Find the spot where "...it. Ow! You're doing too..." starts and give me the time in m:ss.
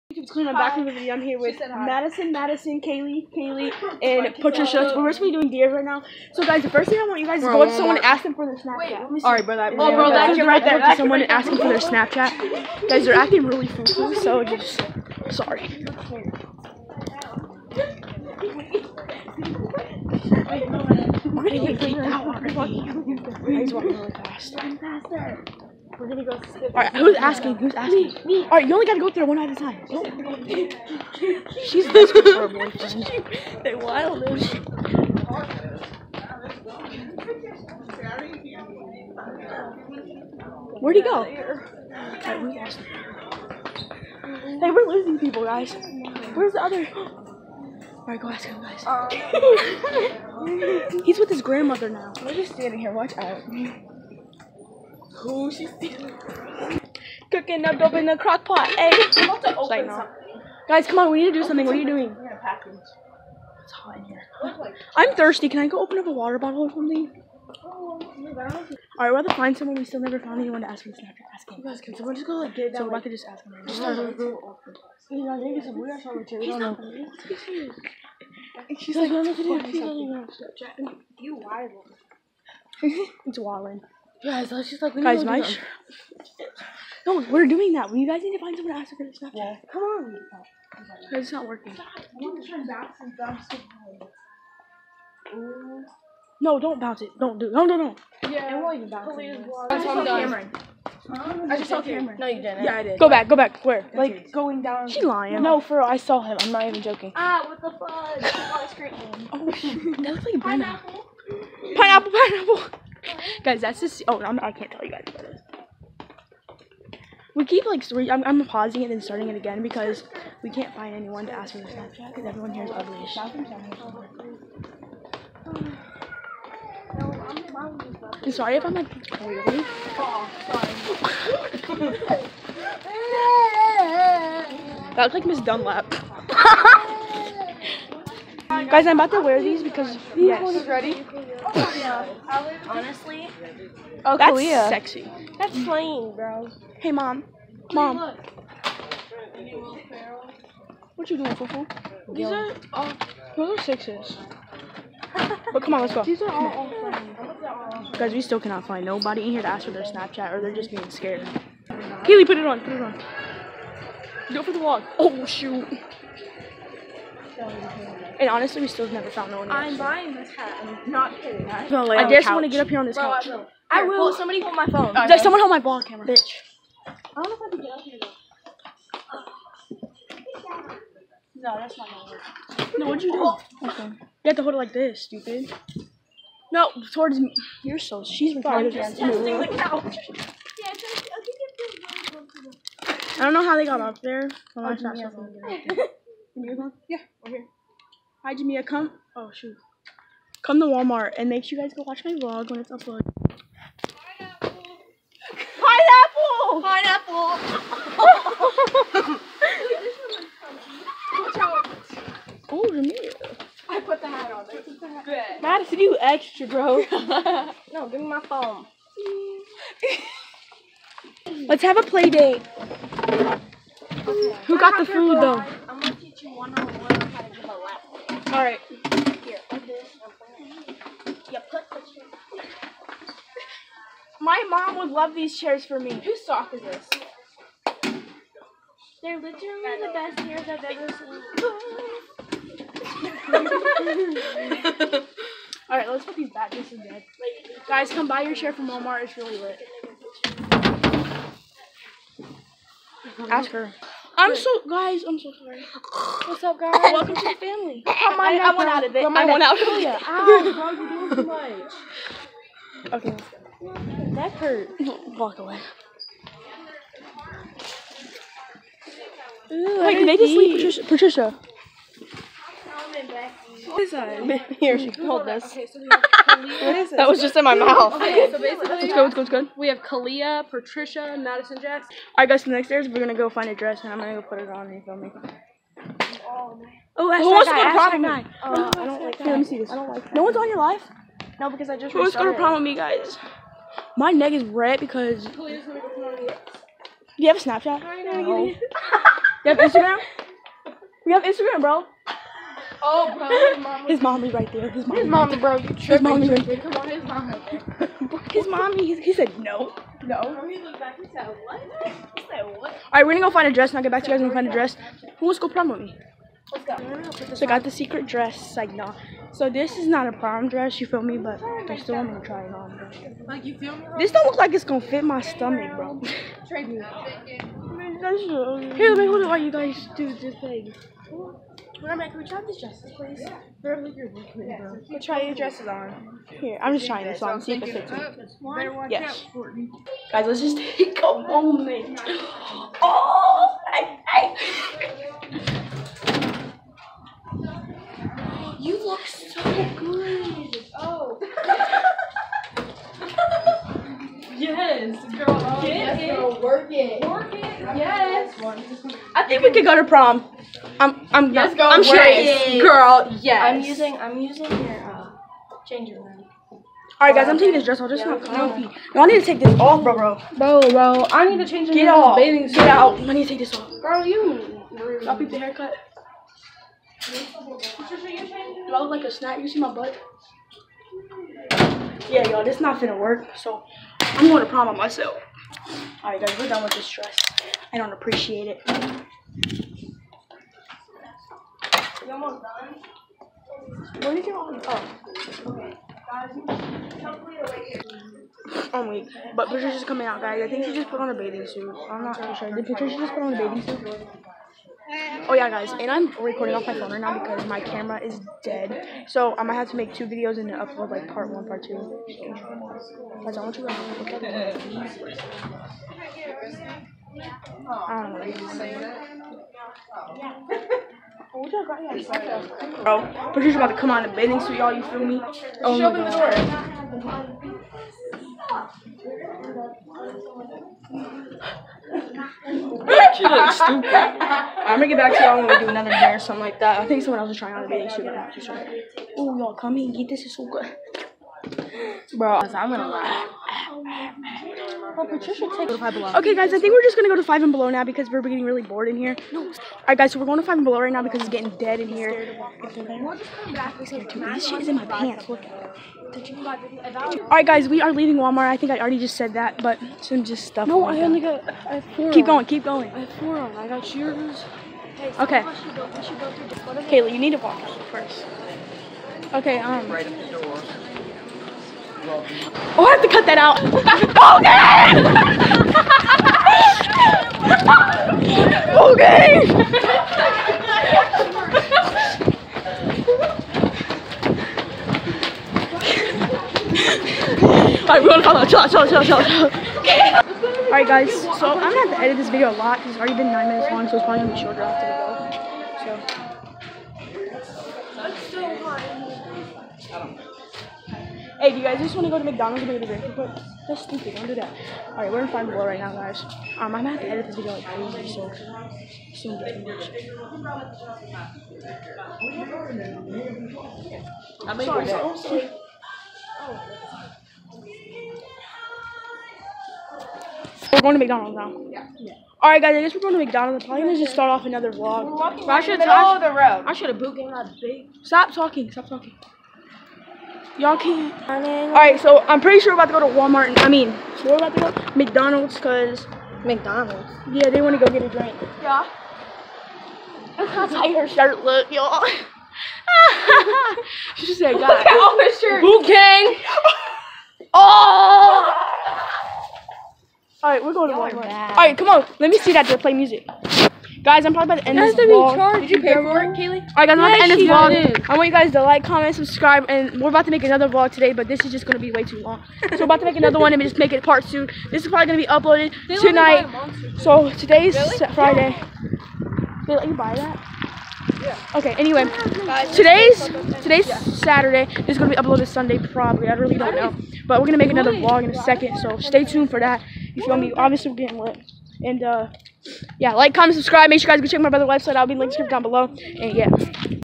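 4:19.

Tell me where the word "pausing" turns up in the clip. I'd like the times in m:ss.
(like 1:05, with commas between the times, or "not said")
1:58.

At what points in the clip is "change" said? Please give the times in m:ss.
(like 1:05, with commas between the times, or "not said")
6:05, 6:11.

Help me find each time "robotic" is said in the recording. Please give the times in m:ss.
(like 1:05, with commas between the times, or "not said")
not said.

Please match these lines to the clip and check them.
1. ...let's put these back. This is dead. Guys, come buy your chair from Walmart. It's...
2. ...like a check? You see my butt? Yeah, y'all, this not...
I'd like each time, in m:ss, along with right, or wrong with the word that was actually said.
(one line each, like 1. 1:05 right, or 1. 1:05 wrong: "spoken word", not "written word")
1. 4:05 right
2. 6:18 wrong: "snack", not "check".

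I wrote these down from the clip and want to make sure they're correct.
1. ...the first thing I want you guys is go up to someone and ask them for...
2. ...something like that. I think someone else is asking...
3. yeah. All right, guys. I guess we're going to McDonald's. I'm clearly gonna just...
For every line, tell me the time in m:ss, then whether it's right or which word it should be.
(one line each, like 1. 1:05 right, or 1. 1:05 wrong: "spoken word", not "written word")
1. 0:06 right
2. 7:16 wrong: "trying", not "asking"
3. 8:41 wrong: "probably", not "clearly".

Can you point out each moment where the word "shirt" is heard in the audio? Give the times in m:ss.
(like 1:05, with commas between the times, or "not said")
9:01, 9:05.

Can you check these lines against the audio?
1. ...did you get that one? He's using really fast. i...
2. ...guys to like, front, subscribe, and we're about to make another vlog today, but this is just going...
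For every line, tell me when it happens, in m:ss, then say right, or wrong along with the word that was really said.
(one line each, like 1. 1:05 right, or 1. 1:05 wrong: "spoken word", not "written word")
1. 0:21 wrong: "walking", not "using"
2. 9:18 wrong: "comment", not "front".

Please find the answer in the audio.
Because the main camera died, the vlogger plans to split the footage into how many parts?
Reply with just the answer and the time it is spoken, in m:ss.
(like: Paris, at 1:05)
2, at 6:51.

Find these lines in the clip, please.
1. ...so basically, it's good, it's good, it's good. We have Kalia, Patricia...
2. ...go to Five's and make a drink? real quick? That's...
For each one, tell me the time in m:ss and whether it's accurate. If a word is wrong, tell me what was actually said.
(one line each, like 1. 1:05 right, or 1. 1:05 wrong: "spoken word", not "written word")
1. 4:38 right
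2. 8:22 wrong: "McDonald", not "Five".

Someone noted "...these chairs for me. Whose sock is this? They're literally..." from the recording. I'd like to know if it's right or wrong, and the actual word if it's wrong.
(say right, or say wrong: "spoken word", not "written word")
right.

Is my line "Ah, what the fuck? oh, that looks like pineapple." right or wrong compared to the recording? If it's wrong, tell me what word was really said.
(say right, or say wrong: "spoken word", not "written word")
right.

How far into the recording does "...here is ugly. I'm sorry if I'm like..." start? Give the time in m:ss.
2:02.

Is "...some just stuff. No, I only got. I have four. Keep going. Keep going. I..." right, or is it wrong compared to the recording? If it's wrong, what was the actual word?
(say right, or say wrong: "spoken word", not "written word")
right.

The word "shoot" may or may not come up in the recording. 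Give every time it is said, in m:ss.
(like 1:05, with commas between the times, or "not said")
2:45, 3:19.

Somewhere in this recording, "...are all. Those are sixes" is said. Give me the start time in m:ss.
2:32.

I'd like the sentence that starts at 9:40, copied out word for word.
If you want me, obviously we're getting lit.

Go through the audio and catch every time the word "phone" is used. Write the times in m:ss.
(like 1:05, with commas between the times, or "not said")
2:54, 3:38, 6:46.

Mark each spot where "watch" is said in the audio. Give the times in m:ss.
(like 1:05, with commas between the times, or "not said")
0:52, 3:21.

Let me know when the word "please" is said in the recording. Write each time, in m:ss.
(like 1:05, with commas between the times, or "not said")
1:39, 5:32.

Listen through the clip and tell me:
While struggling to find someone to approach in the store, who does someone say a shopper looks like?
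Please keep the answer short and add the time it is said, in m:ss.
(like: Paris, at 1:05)
Miss Dunlap, at 2:15.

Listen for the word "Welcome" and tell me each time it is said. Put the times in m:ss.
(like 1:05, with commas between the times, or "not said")
4:16.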